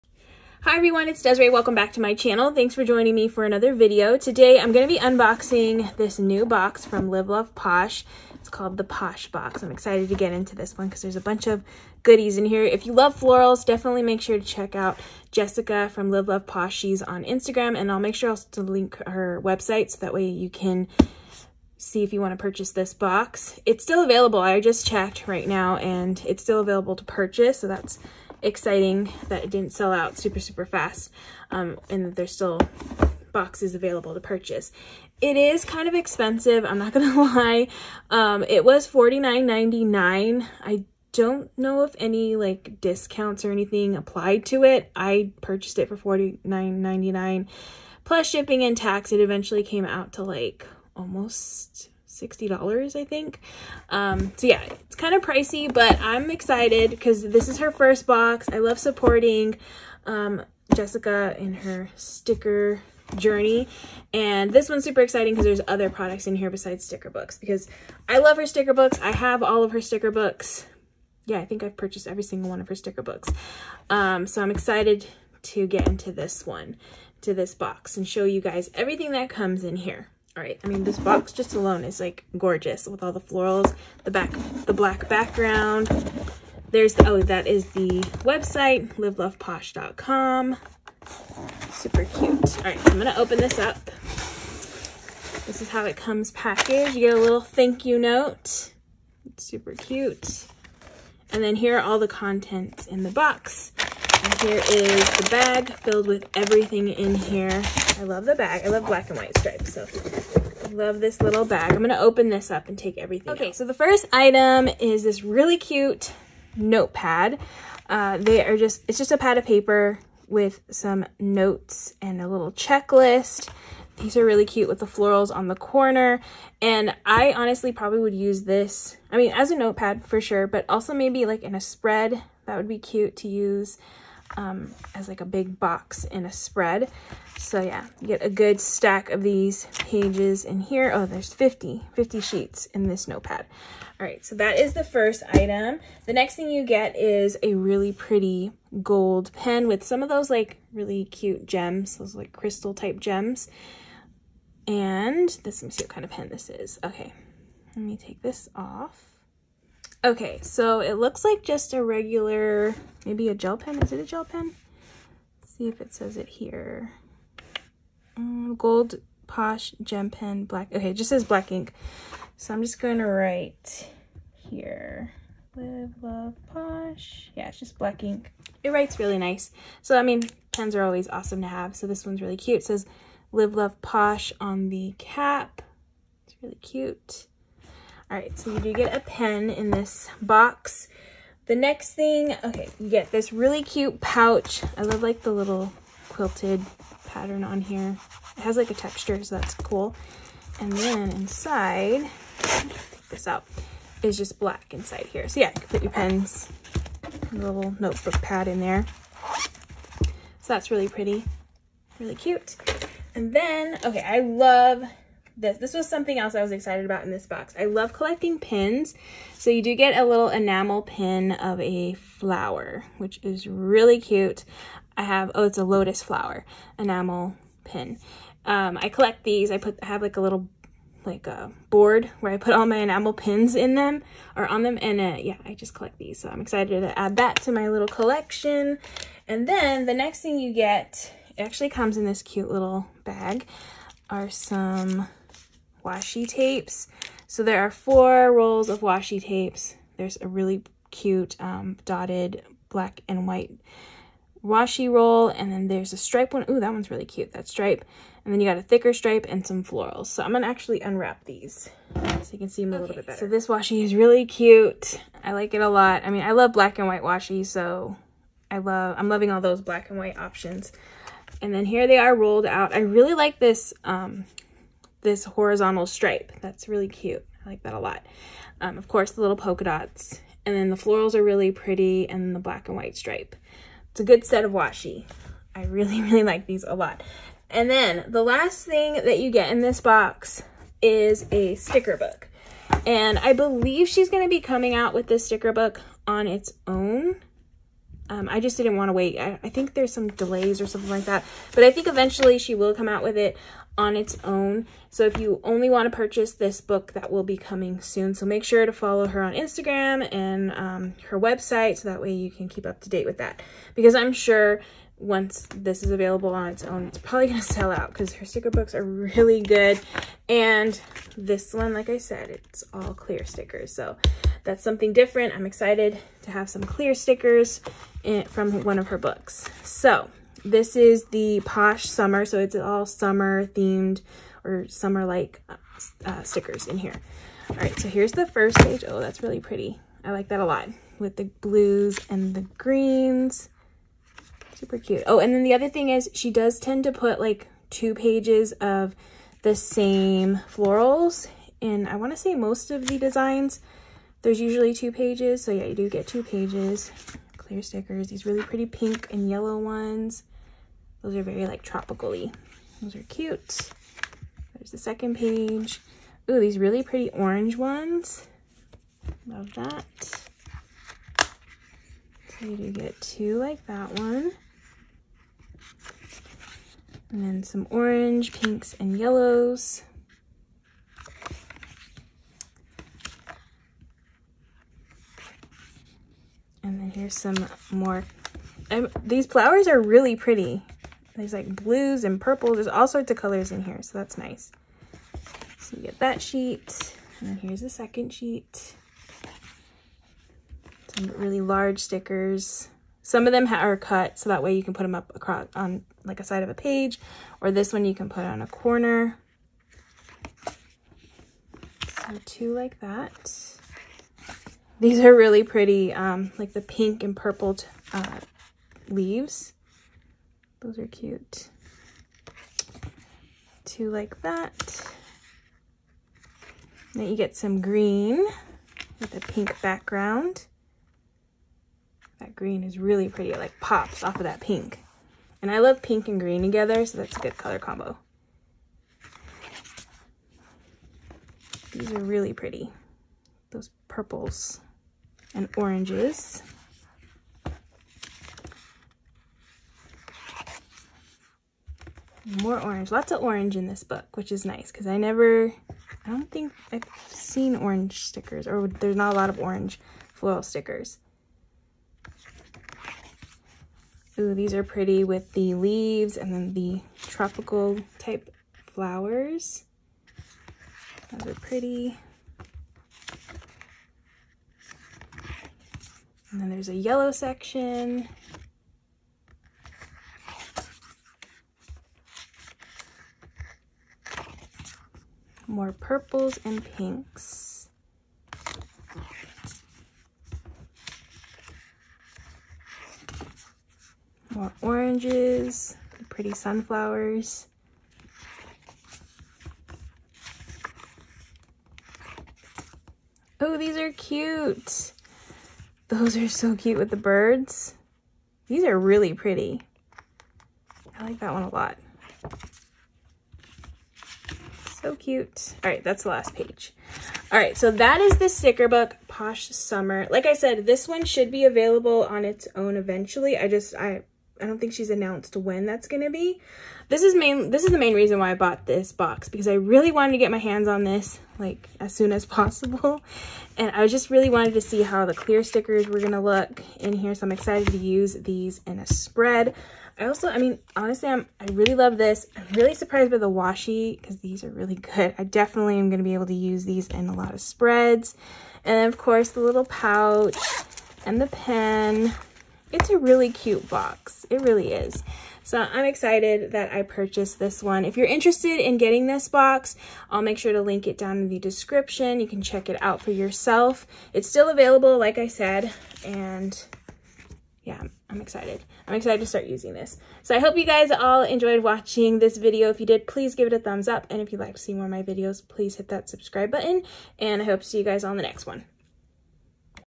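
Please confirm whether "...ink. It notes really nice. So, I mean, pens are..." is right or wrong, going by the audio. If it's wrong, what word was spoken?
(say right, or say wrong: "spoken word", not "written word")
wrong: "writes", not "notes".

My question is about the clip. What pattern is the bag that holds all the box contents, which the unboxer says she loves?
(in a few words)
Black and white stripes.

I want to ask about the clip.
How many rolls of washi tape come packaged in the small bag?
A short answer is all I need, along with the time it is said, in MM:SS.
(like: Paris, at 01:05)
4, at 04:07.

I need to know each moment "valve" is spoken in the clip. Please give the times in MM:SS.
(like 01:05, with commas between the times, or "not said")
not said.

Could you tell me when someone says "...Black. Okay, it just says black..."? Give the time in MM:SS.
02:50.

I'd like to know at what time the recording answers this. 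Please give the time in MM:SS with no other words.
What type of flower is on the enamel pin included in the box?
03:45.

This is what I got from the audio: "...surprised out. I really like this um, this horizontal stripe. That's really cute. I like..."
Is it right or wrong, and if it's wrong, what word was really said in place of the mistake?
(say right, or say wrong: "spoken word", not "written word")
wrong: "rolled", not "surprised".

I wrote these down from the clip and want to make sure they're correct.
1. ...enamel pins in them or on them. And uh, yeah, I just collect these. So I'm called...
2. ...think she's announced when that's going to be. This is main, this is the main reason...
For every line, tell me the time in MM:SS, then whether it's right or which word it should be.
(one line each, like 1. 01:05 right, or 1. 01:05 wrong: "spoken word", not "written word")
1. 03:52 wrong: "excited", not "called"
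2. 08:44 right.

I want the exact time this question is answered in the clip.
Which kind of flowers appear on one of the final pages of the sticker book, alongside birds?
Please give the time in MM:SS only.
08:16.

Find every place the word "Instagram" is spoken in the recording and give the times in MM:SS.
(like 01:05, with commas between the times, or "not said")
00:17, 05:09.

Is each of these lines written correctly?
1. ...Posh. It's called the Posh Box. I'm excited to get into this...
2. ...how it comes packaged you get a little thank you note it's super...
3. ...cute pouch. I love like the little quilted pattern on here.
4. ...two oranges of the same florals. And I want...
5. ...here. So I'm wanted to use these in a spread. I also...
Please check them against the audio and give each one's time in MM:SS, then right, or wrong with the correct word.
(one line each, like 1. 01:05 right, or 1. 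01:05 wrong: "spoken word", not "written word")
1. 00:07 right
2. 01:35 right
3. 03:13 right
4. 05:47 wrong: "pages", not "oranges"
5. 08:56 wrong: "excited", not "wanted".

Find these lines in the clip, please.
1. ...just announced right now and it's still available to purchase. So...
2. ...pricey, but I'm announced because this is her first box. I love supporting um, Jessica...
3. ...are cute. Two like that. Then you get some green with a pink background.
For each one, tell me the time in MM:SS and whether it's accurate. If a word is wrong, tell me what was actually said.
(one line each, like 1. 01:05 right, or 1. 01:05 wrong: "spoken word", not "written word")
1. 00:24 wrong: "checked", not "announced"
2. 00:55 wrong: "excited", not "announced"
3. 07:00 right.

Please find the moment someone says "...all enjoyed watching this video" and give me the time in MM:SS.
09:30.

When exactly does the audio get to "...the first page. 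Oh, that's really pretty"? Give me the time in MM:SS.
05:38.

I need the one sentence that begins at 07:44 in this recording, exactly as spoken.
Ooh, these are pretty with the leaves and then the tropical type flowers.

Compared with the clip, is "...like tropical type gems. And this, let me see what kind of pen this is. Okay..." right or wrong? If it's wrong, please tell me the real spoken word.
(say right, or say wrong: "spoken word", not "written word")
wrong: "crystal", not "tropical".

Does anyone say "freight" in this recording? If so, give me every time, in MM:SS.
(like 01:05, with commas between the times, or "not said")
not said.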